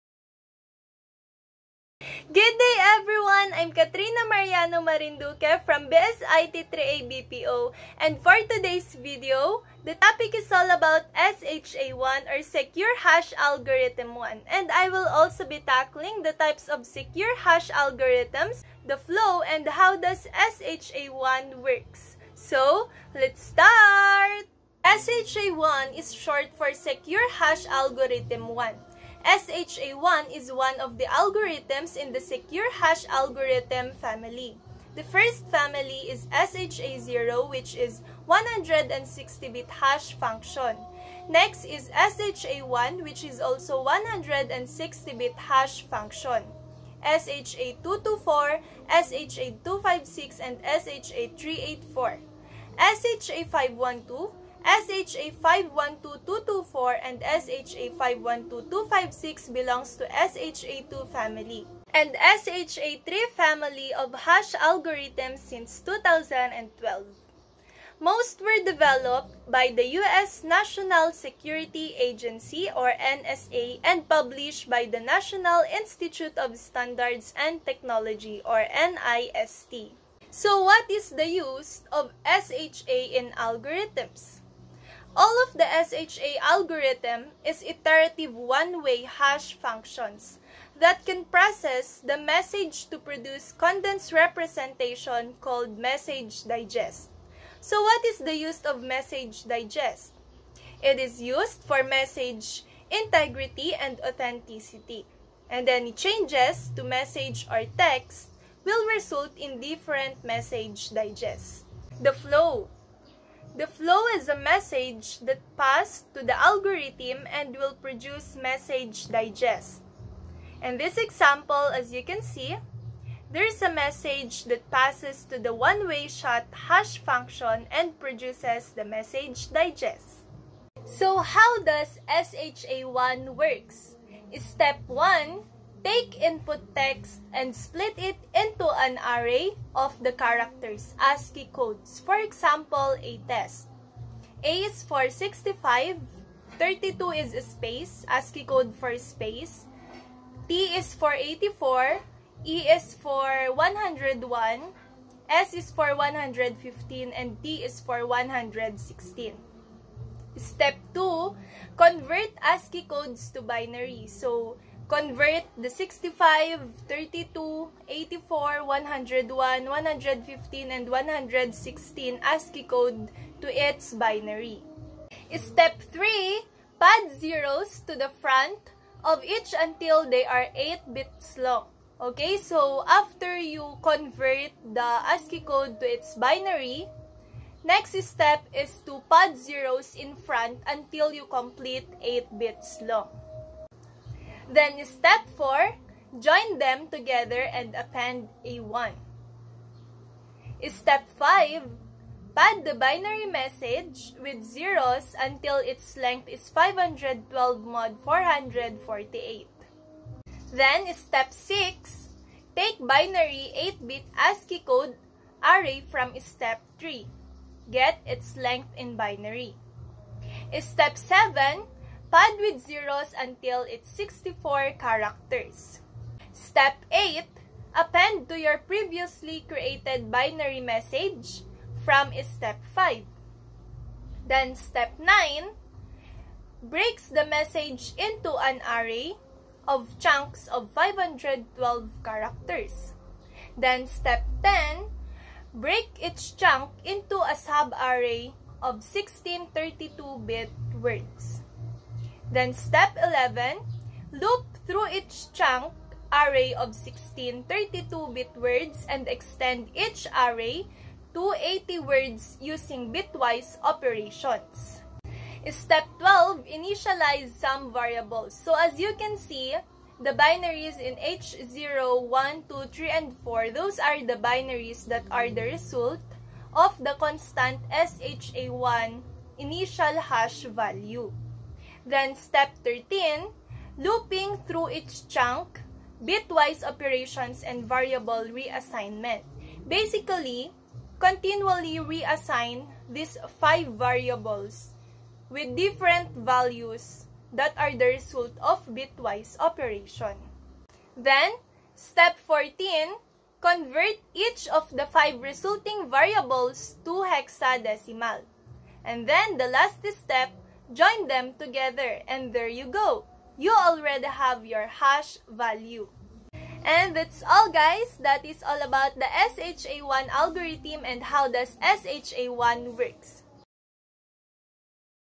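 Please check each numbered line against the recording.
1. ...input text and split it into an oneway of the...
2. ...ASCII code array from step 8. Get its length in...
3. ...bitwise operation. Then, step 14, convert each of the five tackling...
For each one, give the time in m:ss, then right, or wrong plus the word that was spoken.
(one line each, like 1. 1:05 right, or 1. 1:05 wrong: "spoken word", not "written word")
1. 2:16 wrong: "array", not "oneway"
2. 3:34 wrong: "3", not "8"
3. 4:58 wrong: "resulting", not "tackling".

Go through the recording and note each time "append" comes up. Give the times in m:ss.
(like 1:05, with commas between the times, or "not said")
3:17, 3:47.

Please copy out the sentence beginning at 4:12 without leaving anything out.
Then step 11, loop through each chunk array of 16 32-bit words and extend each array to 80 words using bitwise operations.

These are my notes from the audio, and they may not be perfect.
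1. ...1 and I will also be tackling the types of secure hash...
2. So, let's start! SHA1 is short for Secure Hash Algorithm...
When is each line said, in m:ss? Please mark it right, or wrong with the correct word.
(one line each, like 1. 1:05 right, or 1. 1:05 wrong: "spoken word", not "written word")
1. 0:14 right
2. 0:22 right.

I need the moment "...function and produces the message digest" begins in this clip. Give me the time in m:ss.
2:06.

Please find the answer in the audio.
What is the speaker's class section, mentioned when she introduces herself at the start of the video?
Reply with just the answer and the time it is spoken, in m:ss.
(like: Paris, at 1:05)
BSIT 3A BPO, at 0:05.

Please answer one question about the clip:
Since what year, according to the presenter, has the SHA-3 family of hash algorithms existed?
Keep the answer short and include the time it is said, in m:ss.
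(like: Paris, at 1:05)
2012, at 1:05.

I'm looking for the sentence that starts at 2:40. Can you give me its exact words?
Step 2, convert ASCII codes to binary.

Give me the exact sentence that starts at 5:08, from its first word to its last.
And then, the last step Join them together and there you go.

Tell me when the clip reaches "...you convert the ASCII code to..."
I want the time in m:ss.
3:03.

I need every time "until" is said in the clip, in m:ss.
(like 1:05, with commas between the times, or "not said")
2:59, 3:10, 3:25, 3:43.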